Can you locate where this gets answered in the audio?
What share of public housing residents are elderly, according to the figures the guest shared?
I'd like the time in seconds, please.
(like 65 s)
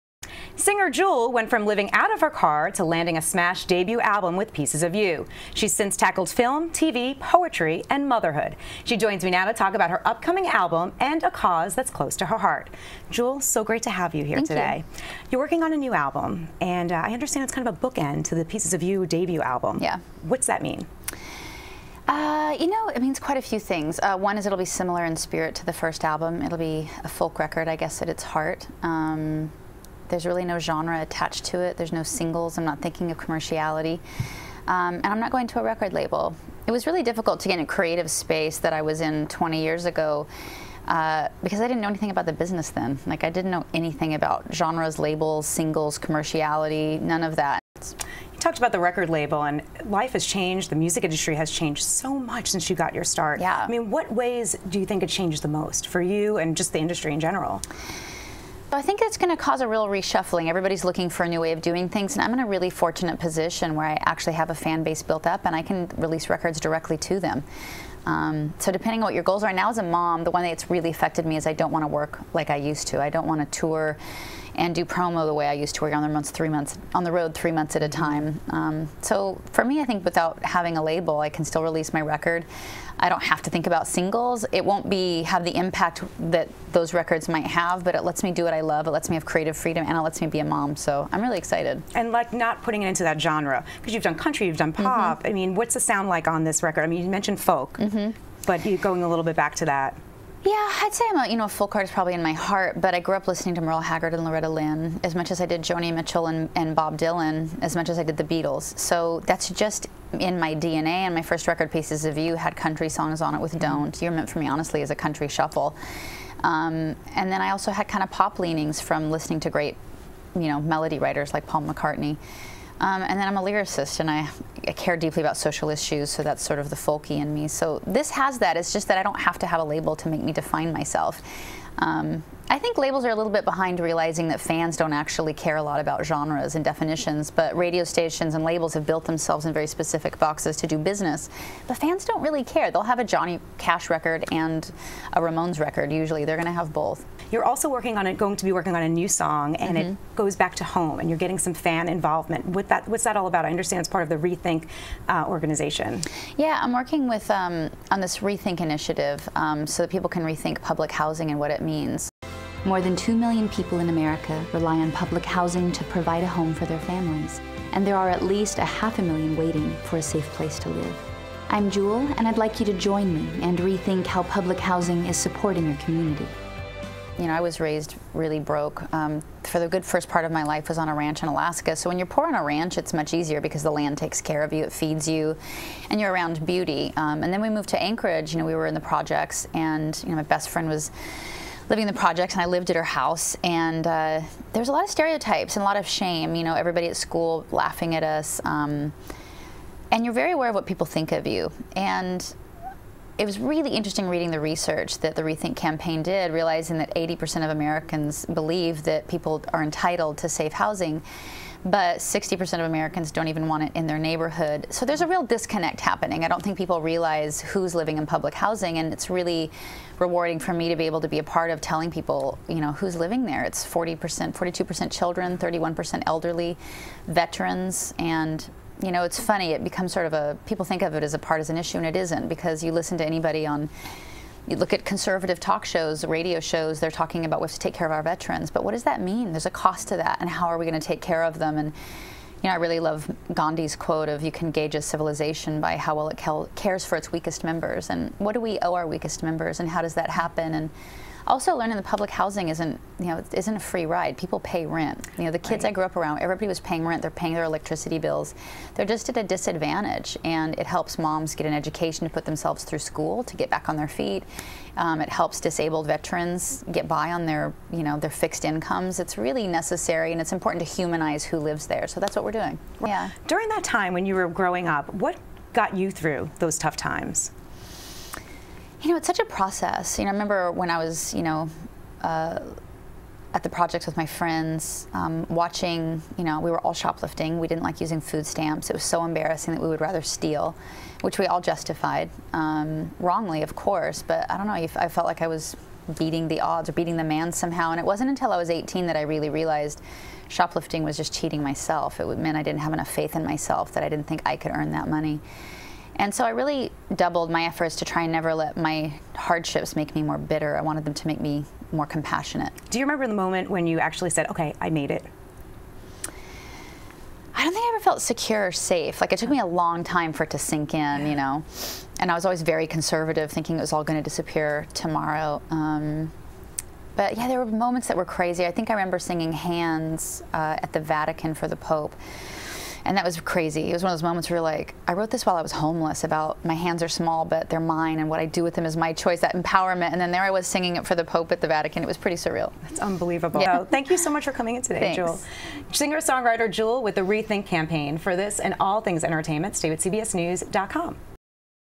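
225 s.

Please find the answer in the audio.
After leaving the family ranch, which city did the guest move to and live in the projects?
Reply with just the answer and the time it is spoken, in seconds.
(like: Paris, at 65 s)
Anchorage, at 187 s.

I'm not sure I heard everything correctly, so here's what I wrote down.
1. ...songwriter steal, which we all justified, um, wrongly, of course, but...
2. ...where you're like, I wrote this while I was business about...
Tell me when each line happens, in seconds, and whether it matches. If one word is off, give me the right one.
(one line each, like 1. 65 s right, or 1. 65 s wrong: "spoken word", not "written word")
1. 289 s wrong: "rather", not "songwriter"
2. 334 s wrong: "homeless", not "business".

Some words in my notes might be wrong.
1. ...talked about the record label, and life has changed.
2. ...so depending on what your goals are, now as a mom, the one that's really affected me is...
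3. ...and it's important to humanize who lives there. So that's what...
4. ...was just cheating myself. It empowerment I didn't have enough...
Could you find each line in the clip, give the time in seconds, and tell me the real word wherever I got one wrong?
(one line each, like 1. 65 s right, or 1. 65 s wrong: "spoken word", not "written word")
1. 48 s right
2. 68 s right
3. 270 s right
4. 300 s wrong: "meant", not "empowerment".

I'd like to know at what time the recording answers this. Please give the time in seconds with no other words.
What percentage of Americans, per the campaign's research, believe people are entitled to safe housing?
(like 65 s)
206 s.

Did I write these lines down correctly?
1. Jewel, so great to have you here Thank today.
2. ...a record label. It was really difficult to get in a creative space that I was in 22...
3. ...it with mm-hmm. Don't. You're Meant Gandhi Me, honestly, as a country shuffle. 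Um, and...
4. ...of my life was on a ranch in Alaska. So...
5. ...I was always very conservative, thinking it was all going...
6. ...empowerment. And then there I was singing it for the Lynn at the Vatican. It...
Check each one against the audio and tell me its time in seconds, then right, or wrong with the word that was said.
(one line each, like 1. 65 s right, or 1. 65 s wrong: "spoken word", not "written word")
1. 13 s right
2. 35 s wrong: "20", not "22"
3. 113 s wrong: "For", not "Gandhi"
4. 180 s right
5. 322 s right
6. 339 s wrong: "Pope", not "Lynn".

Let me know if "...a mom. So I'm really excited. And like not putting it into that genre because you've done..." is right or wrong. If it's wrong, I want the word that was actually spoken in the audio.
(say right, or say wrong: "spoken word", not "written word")
right.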